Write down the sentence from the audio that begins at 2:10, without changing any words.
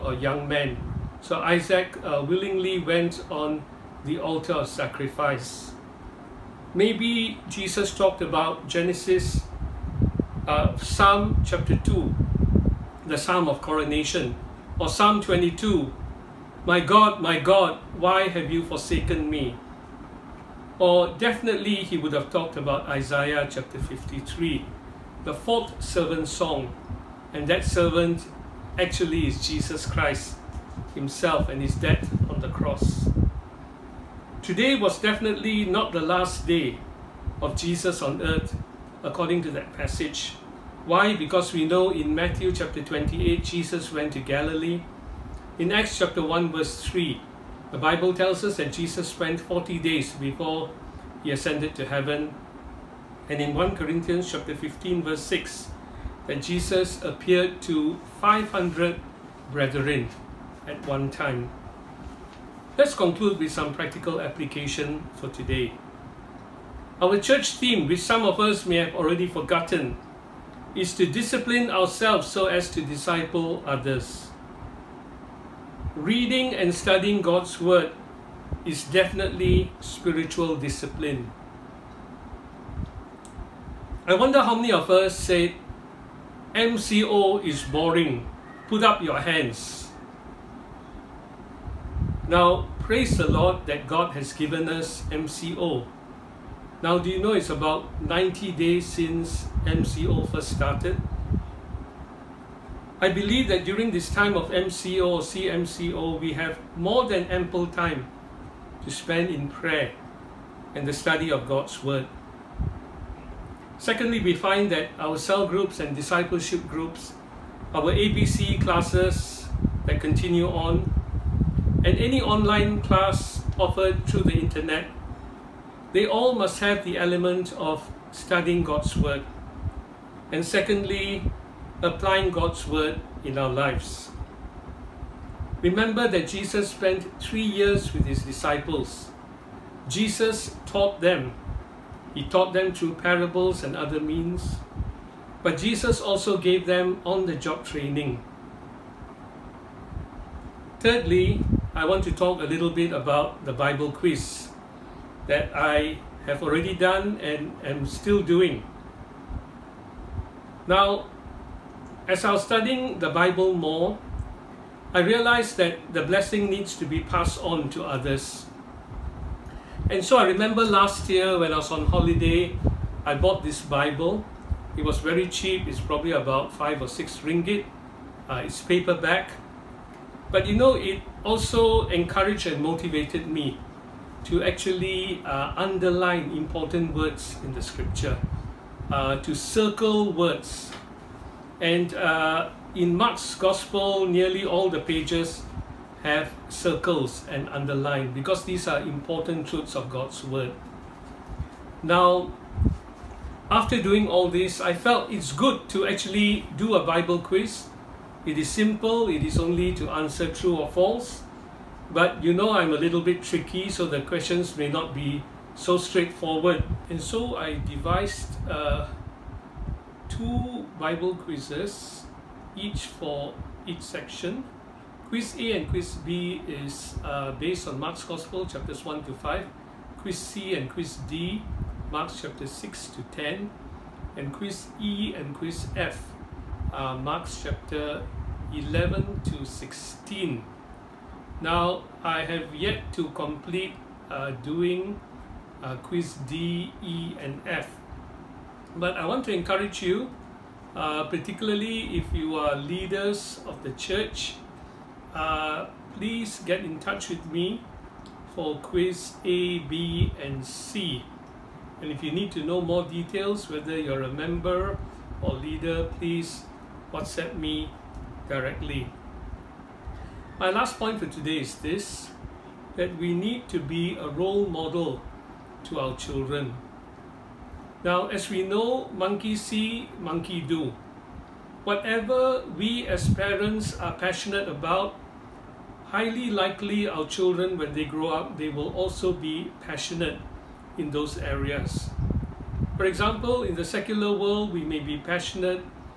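And secondly, applying God's Word in our lives.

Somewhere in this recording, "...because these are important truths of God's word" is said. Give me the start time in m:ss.
3:18.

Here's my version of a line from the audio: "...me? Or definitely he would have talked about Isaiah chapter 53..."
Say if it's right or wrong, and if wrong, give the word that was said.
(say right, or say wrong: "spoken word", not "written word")
right.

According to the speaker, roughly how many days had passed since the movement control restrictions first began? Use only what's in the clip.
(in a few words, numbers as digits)
90.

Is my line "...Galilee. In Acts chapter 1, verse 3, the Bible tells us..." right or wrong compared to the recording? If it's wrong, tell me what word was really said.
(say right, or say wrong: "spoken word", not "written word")
right.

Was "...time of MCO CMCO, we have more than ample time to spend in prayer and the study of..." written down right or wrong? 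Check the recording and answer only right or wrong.
right.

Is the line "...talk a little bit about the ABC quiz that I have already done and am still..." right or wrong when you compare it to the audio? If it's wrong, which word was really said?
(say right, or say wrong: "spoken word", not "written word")
wrong: "Bible", not "ABC".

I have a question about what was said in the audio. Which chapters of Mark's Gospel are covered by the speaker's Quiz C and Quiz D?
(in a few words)
Chapters 6 to 10.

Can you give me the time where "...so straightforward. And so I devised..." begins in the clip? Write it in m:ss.
3:35.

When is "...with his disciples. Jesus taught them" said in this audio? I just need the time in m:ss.
2:17.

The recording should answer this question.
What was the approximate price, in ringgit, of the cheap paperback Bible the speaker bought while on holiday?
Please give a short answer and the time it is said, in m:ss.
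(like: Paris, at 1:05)
5 or 6 ringgit, at 2:56.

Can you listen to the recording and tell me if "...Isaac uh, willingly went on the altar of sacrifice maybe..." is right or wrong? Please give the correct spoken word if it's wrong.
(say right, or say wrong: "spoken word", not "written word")
right.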